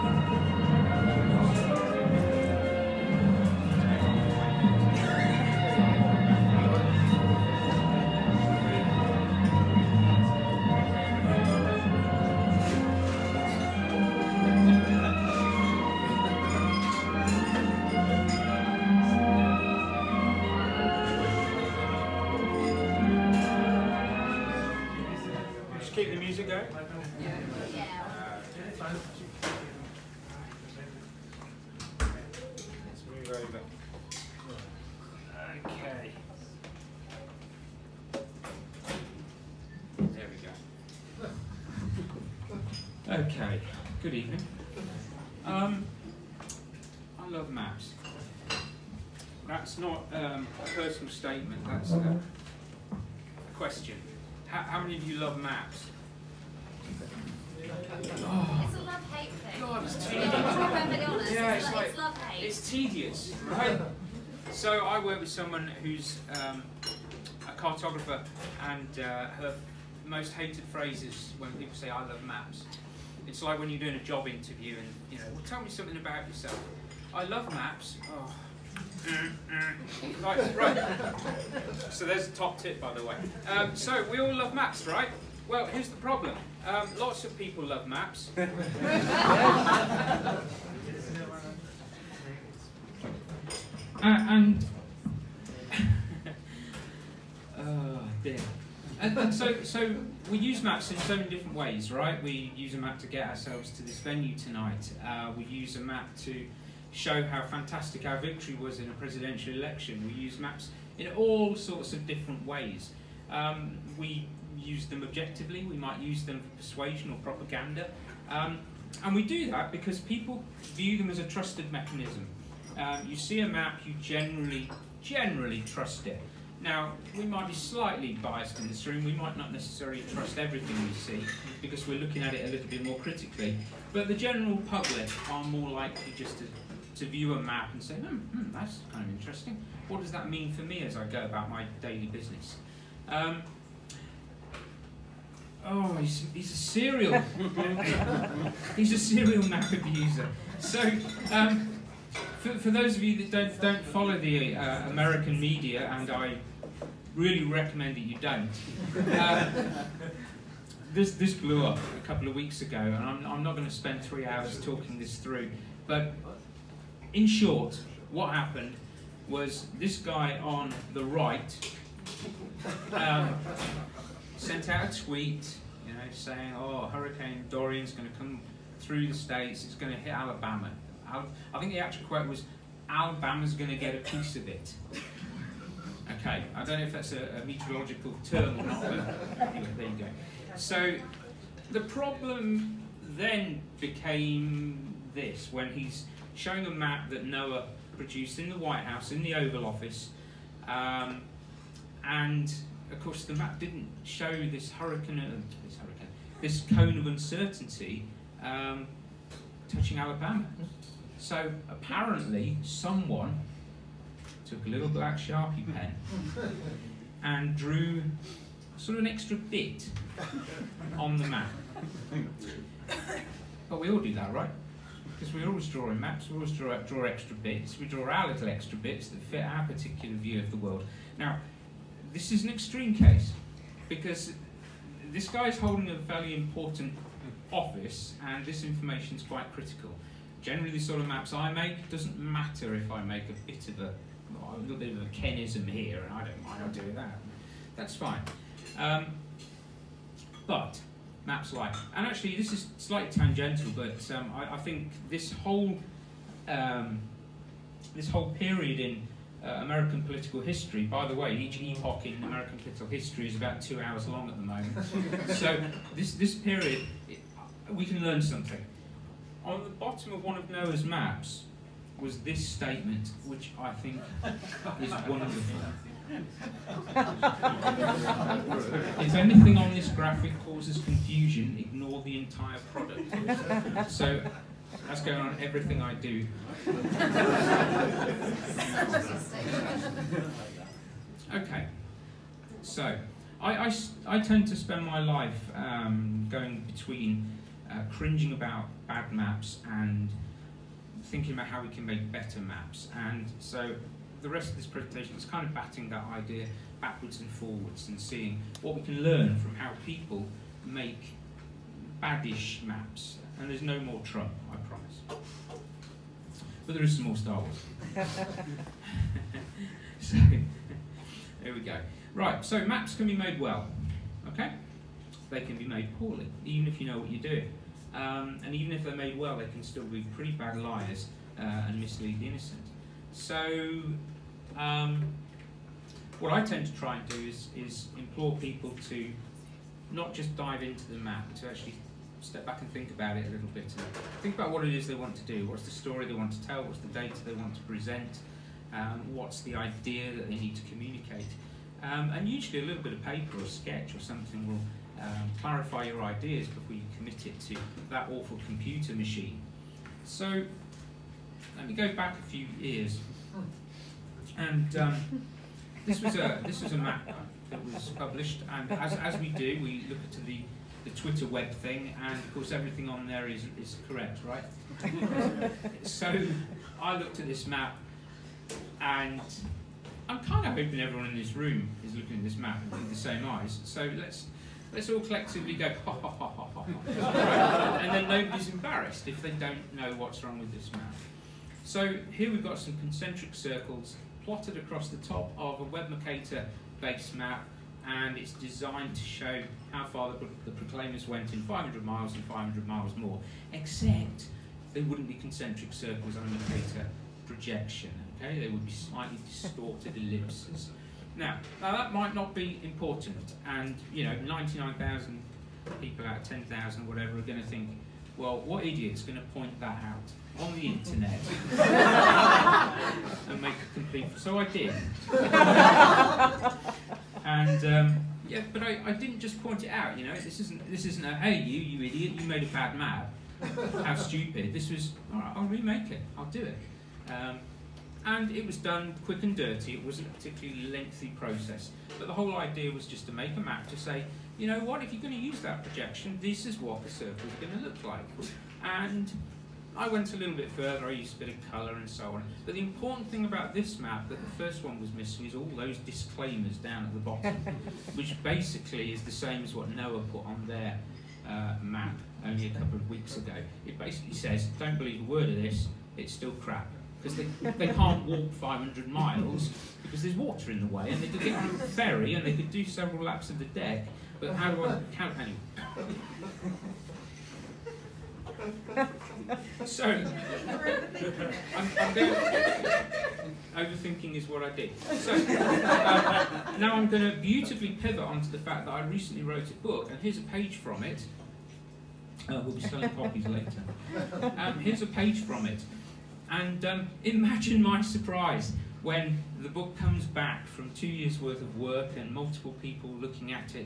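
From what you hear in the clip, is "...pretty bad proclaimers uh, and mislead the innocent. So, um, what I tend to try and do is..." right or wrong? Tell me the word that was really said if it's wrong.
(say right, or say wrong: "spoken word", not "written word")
wrong: "liars", not "proclaimers".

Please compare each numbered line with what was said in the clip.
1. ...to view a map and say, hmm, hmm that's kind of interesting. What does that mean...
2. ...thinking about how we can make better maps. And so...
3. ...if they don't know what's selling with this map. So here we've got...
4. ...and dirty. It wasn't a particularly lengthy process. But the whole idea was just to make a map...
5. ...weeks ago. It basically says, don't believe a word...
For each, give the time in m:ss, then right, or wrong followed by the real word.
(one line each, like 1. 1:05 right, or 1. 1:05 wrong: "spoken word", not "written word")
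1. 2:16 right
2. 5:01 right
3. 6:29 wrong: "wrong", not "selling"
4. 7:19 right
5. 7:42 right.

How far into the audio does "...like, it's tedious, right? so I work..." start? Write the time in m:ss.
1:01.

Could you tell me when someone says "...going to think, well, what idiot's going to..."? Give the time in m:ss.
6:57.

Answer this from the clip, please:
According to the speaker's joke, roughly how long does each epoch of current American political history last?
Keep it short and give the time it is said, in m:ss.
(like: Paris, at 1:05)
2 hours, at 4:23.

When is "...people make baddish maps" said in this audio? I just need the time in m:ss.
5:09.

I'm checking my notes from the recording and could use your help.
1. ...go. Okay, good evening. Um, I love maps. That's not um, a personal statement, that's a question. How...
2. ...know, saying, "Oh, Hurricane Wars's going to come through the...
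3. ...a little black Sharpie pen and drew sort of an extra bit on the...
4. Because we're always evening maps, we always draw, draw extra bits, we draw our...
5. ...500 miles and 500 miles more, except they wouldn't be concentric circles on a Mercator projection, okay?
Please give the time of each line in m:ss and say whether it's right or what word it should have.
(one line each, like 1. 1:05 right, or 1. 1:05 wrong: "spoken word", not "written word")
1. 0:41 right
2. 2:55 wrong: "Dorian", not "Wars"
3. 3:34 right
4. 3:45 wrong: "drawing", not "evening"
5. 6:41 right.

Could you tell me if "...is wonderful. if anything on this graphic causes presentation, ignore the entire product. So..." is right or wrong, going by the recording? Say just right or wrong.
wrong.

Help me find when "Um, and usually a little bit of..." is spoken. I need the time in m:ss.
5:51.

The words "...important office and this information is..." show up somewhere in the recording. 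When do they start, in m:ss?
3:56.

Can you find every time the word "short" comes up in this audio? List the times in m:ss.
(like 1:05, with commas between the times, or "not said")
2:47.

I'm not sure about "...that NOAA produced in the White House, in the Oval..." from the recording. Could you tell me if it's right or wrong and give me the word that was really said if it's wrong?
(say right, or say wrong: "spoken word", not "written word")
right.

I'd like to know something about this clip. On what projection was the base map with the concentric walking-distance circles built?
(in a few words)
Web Mercator.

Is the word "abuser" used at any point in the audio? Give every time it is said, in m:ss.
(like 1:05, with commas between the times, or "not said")
2:29.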